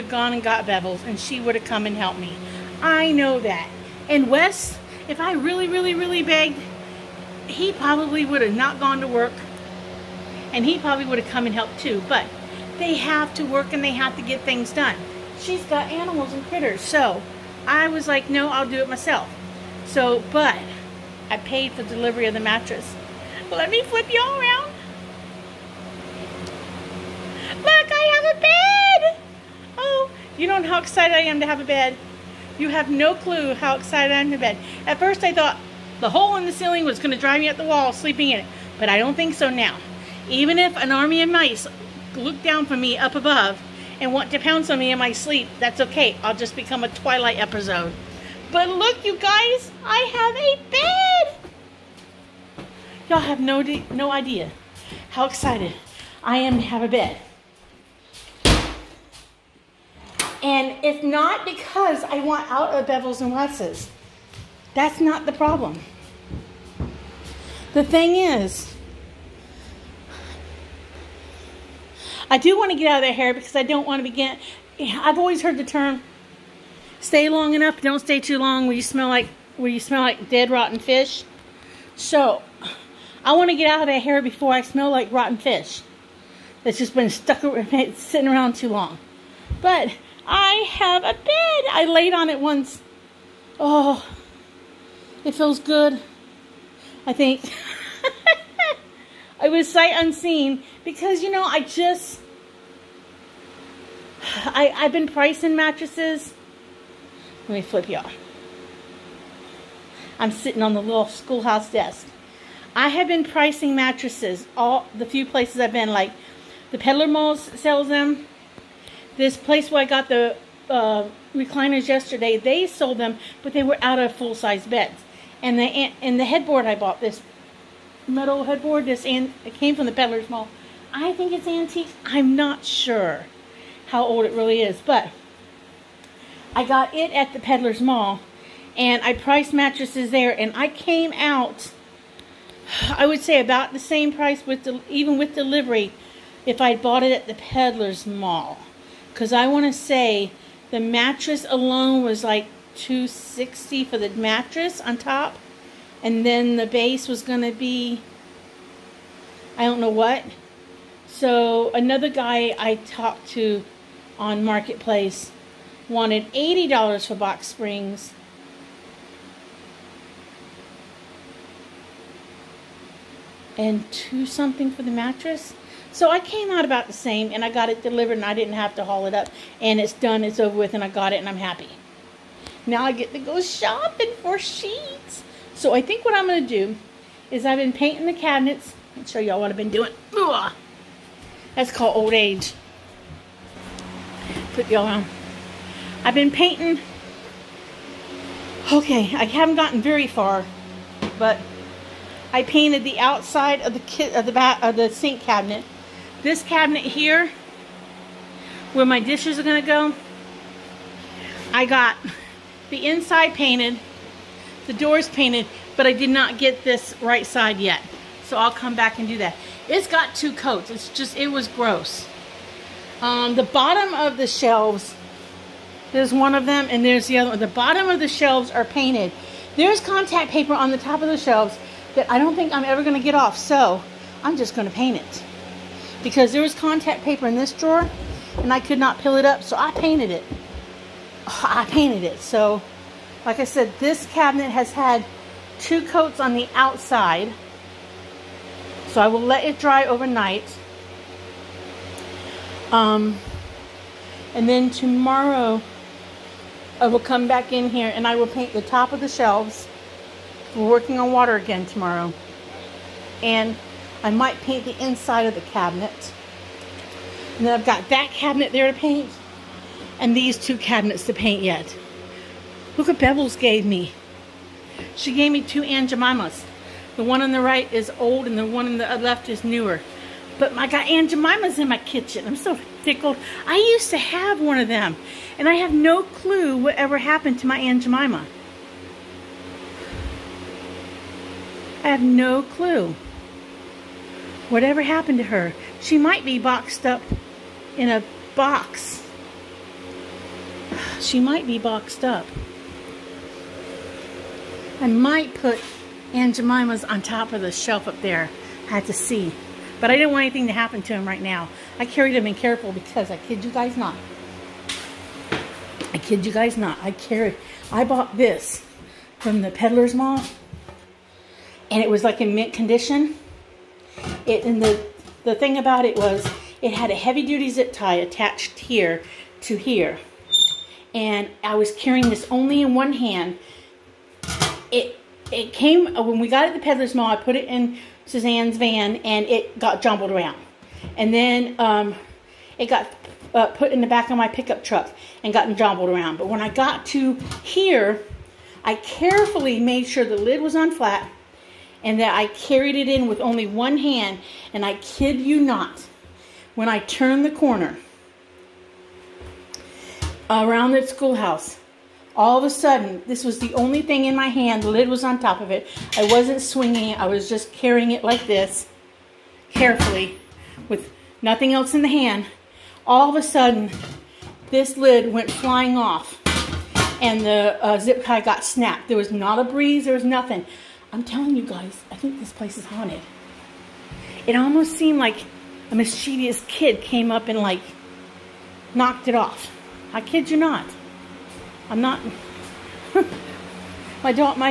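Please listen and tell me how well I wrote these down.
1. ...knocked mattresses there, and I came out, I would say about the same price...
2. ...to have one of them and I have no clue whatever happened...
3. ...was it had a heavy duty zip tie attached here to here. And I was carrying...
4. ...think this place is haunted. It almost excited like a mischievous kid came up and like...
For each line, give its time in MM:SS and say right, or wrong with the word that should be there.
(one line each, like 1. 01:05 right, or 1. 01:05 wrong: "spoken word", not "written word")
1. 02:19 wrong: "priced", not "knocked"
2. 04:43 right
3. 05:25 right
4. 06:21 wrong: "seemed", not "excited".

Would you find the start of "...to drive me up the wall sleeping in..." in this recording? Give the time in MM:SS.
00:37.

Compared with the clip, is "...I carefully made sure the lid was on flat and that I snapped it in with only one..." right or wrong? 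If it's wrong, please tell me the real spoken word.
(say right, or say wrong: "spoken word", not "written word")
wrong: "carried", not "snapped".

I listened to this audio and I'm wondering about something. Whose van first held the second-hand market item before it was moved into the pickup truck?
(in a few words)
Suzanne's.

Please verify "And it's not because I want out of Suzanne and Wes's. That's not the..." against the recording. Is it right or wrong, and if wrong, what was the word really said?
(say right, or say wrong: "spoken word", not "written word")
wrong: "Bevels", not "Suzanne".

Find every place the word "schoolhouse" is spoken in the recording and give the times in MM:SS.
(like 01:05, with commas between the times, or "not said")
01:51, 06:00.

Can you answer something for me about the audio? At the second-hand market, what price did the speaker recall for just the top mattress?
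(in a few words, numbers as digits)
260.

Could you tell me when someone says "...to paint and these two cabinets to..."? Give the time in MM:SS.
04:28.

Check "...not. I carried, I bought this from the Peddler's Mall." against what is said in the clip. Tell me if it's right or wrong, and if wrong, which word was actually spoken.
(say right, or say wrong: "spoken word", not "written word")
right.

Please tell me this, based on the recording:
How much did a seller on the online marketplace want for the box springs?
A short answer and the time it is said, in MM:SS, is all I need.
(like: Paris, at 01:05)
$80, at 02:46.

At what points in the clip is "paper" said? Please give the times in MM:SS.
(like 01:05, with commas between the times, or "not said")
03:50, 03:57.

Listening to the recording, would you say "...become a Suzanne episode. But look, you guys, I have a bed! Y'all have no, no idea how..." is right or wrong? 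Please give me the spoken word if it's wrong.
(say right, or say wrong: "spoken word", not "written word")
wrong: "Twilight", not "Suzanne".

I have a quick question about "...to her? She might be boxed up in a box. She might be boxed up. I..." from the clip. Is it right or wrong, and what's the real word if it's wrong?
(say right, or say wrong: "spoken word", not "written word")
right.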